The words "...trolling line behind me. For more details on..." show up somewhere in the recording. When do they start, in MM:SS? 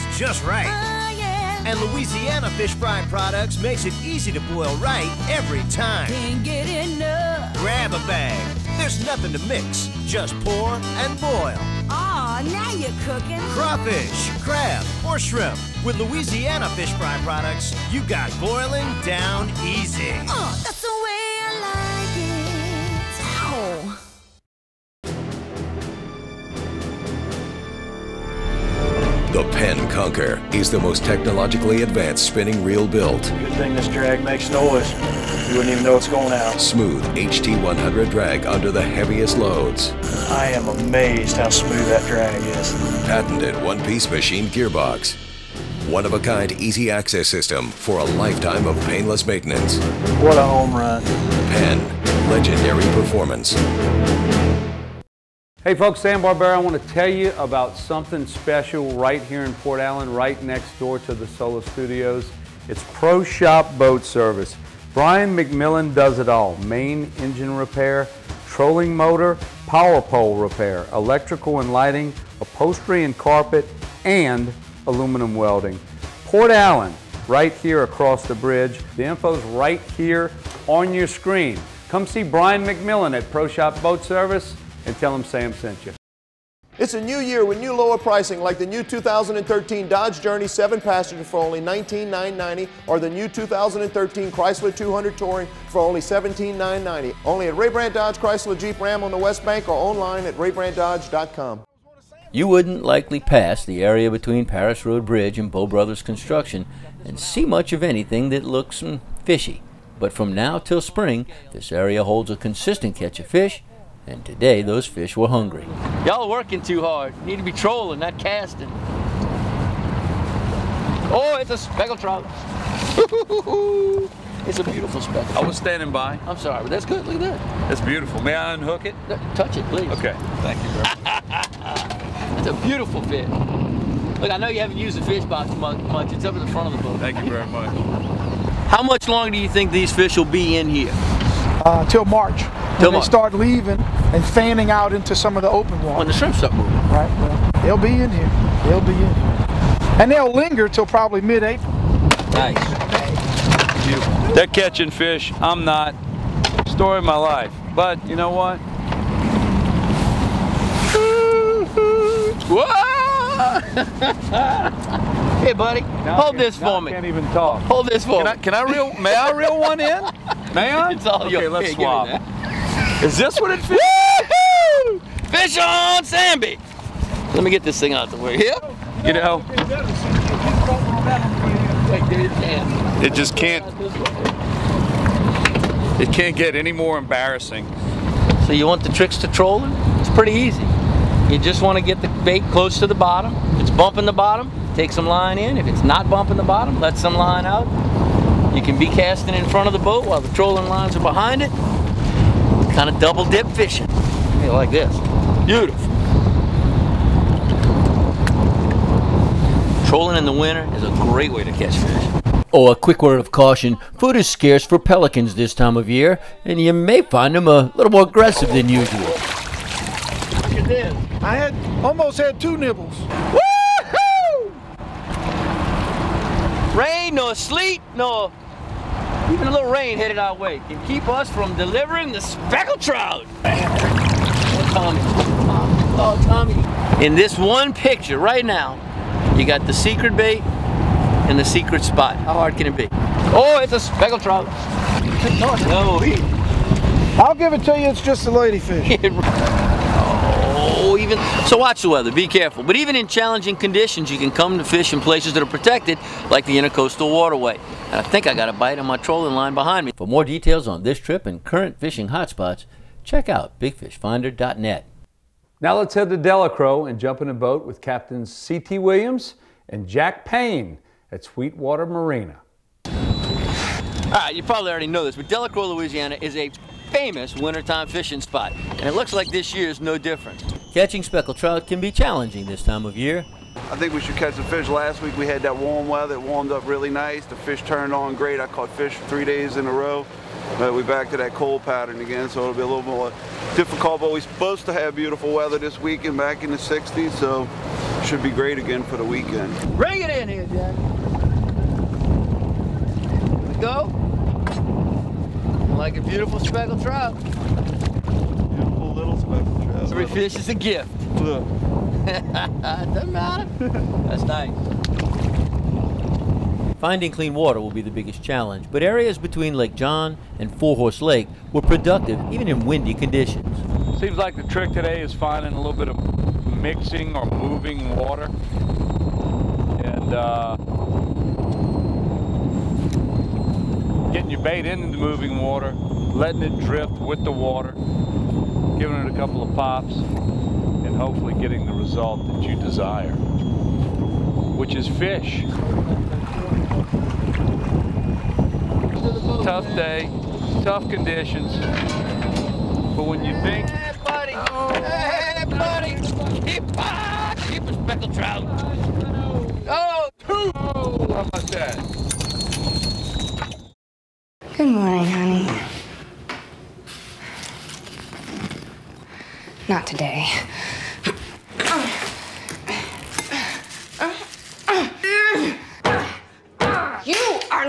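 04:18.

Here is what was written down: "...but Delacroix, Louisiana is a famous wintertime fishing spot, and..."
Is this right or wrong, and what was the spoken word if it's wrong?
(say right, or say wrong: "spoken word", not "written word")
right.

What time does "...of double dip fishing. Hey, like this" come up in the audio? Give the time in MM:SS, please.
03:22.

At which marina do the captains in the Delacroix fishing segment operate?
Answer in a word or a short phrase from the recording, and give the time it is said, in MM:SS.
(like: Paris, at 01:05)
Sweetwater Marina, at 04:31.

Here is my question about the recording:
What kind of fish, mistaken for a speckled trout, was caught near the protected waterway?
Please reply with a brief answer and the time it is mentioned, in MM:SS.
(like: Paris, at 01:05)
Ladyfish, at 04:08.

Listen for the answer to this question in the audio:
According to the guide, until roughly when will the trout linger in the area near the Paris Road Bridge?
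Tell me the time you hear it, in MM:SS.
02:31.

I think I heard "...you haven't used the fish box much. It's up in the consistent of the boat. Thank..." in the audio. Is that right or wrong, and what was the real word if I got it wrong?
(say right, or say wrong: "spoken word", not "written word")
wrong: "front", not "consistent".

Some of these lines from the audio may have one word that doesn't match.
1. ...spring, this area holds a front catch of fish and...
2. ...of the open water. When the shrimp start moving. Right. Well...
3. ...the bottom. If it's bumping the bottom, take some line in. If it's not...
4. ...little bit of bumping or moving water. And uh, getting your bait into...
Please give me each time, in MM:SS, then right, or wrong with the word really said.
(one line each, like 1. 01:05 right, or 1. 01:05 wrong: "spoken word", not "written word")
1. 01:50 wrong: "consistent", not "front"
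2. 02:25 right
3. 03:12 right
4. 05:25 wrong: "mixing", not "bumping".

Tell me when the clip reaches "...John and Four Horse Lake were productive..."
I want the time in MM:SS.
05:19.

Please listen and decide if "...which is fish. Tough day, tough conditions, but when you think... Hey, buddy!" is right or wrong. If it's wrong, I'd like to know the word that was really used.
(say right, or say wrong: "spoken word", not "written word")
right.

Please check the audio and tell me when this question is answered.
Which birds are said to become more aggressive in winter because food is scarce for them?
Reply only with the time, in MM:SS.
03:34.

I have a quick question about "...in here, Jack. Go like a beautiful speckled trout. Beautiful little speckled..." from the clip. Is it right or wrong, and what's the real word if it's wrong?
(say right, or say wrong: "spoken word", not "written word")
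right.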